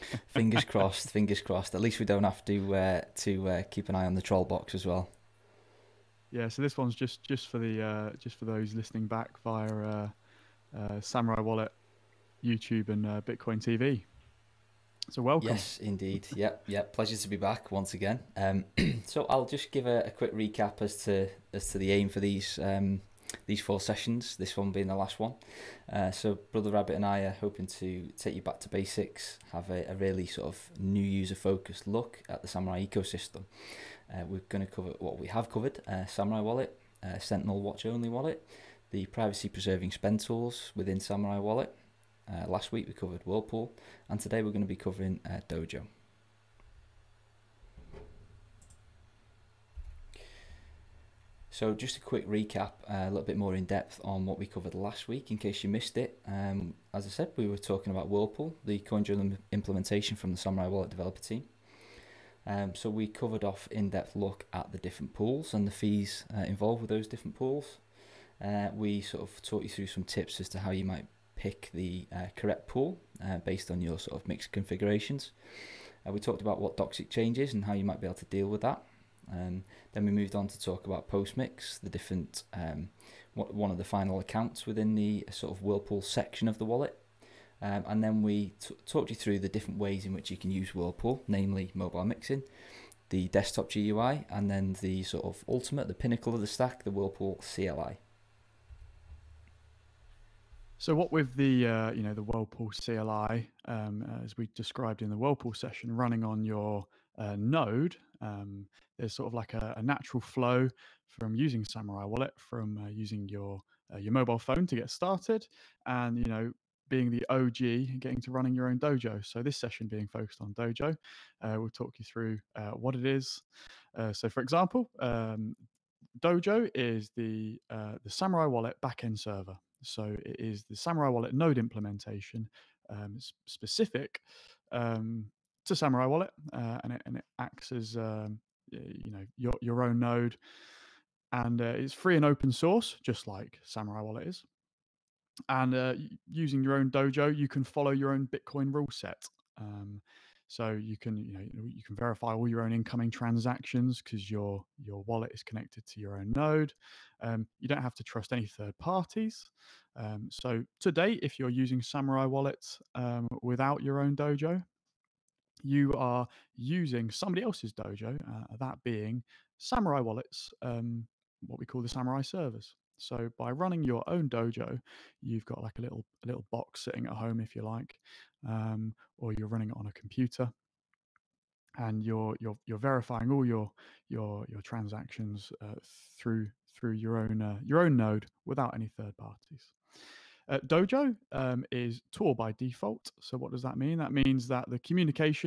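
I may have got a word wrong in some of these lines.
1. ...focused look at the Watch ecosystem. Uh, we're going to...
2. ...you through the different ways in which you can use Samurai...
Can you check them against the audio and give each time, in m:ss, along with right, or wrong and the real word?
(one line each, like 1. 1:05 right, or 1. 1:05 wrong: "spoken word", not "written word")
1. 0:31 wrong: "Samourai", not "Watch"
2. 1:29 wrong: "Whirlpool", not "Samurai".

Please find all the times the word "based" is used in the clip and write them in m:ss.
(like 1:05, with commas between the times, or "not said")
1:13.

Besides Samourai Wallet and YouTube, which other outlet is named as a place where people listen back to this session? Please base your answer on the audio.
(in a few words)
Bitcoin TV.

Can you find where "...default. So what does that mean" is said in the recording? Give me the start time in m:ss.
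3:12.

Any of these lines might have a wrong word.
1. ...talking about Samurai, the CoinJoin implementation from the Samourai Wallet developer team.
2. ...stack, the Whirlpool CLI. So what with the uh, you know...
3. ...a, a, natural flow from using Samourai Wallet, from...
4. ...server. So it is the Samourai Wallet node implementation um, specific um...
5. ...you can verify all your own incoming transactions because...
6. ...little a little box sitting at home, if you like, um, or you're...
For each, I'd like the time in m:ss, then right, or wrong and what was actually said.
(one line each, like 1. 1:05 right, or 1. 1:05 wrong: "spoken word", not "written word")
1. 0:57 wrong: "Whirlpool", not "Samurai"
2. 1:36 right
3. 1:49 right
4. 2:09 right
5. 2:31 right
6. 2:55 right.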